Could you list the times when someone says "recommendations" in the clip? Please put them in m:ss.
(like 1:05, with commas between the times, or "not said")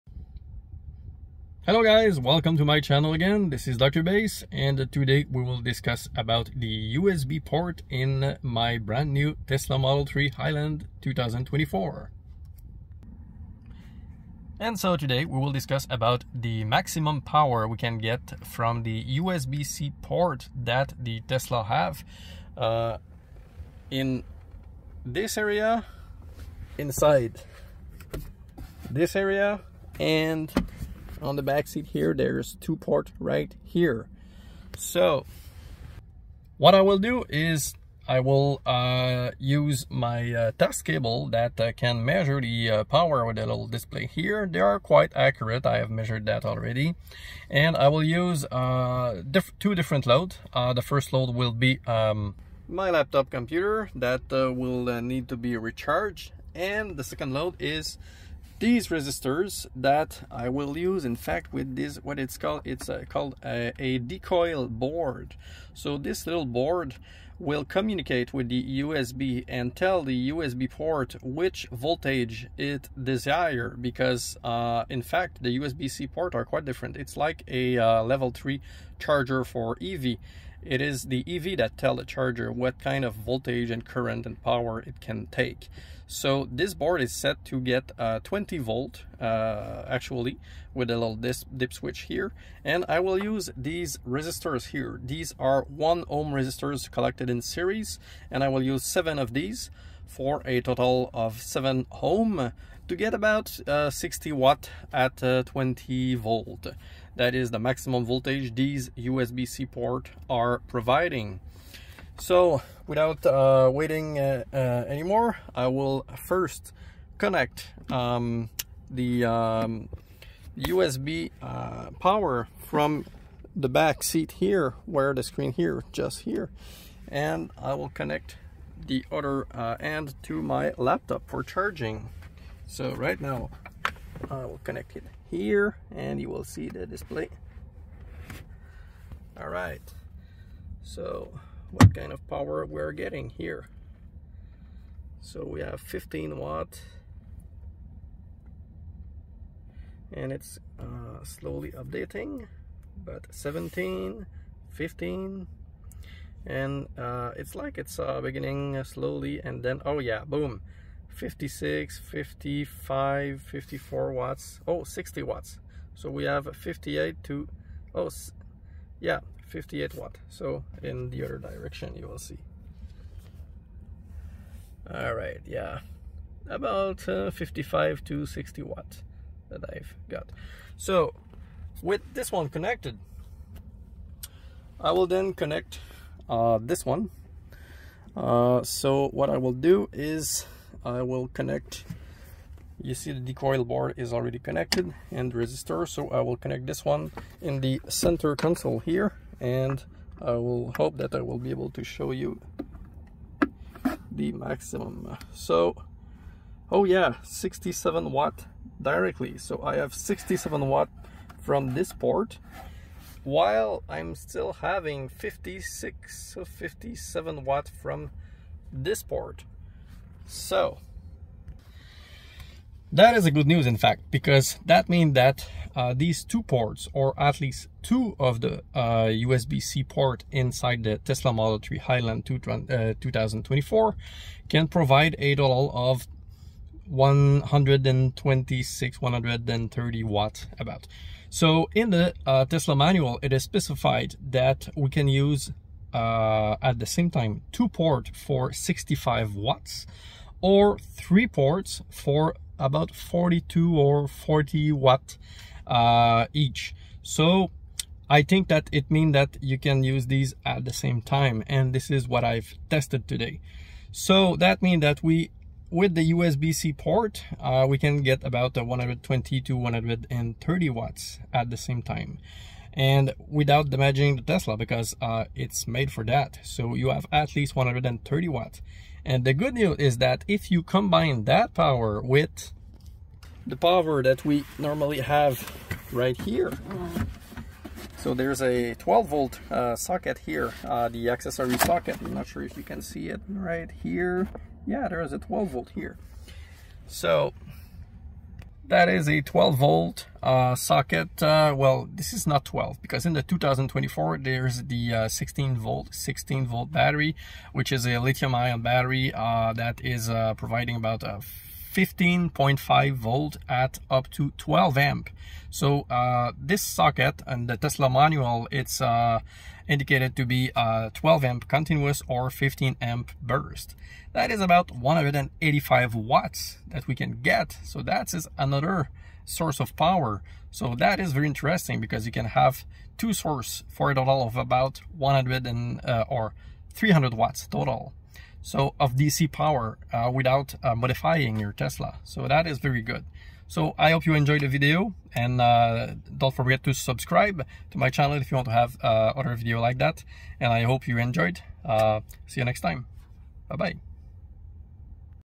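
not said.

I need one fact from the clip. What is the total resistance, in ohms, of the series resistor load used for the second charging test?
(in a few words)
7 ohm.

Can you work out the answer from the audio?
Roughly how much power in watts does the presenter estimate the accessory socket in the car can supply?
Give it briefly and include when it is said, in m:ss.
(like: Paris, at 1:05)
185 watts, at 5:24.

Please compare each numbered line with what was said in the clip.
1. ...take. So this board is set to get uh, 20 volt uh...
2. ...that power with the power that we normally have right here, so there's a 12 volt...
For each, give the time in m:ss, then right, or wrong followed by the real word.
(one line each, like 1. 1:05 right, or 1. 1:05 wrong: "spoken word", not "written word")
1. 1:25 right
2. 4:41 right.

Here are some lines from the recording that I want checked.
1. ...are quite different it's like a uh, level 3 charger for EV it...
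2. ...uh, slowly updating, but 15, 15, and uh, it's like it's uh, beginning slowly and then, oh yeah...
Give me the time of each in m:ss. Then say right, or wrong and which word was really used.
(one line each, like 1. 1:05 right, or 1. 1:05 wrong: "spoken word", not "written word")
1. 1:16 right
2. 2:30 wrong: "17", not "15".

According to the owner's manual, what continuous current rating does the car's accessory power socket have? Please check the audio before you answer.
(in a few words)
12 amp.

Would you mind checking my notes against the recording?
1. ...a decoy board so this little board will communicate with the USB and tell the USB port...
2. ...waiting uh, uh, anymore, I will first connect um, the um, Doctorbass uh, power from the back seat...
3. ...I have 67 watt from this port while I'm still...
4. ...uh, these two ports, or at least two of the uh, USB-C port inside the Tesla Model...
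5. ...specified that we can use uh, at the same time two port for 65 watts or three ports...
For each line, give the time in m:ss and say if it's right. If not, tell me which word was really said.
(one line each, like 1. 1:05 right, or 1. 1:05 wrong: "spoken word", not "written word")
1. 1:03 right
2. 1:53 wrong: "USB", not "Doctorbass"
3. 3:29 right
4. 3:45 right
5. 4:03 right.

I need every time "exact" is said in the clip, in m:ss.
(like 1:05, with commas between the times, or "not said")
not said.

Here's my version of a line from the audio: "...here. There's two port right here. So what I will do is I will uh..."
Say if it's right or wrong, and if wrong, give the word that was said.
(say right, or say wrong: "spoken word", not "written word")
right.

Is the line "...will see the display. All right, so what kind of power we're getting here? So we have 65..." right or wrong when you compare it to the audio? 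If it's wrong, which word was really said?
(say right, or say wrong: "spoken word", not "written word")
wrong: "15", not "65".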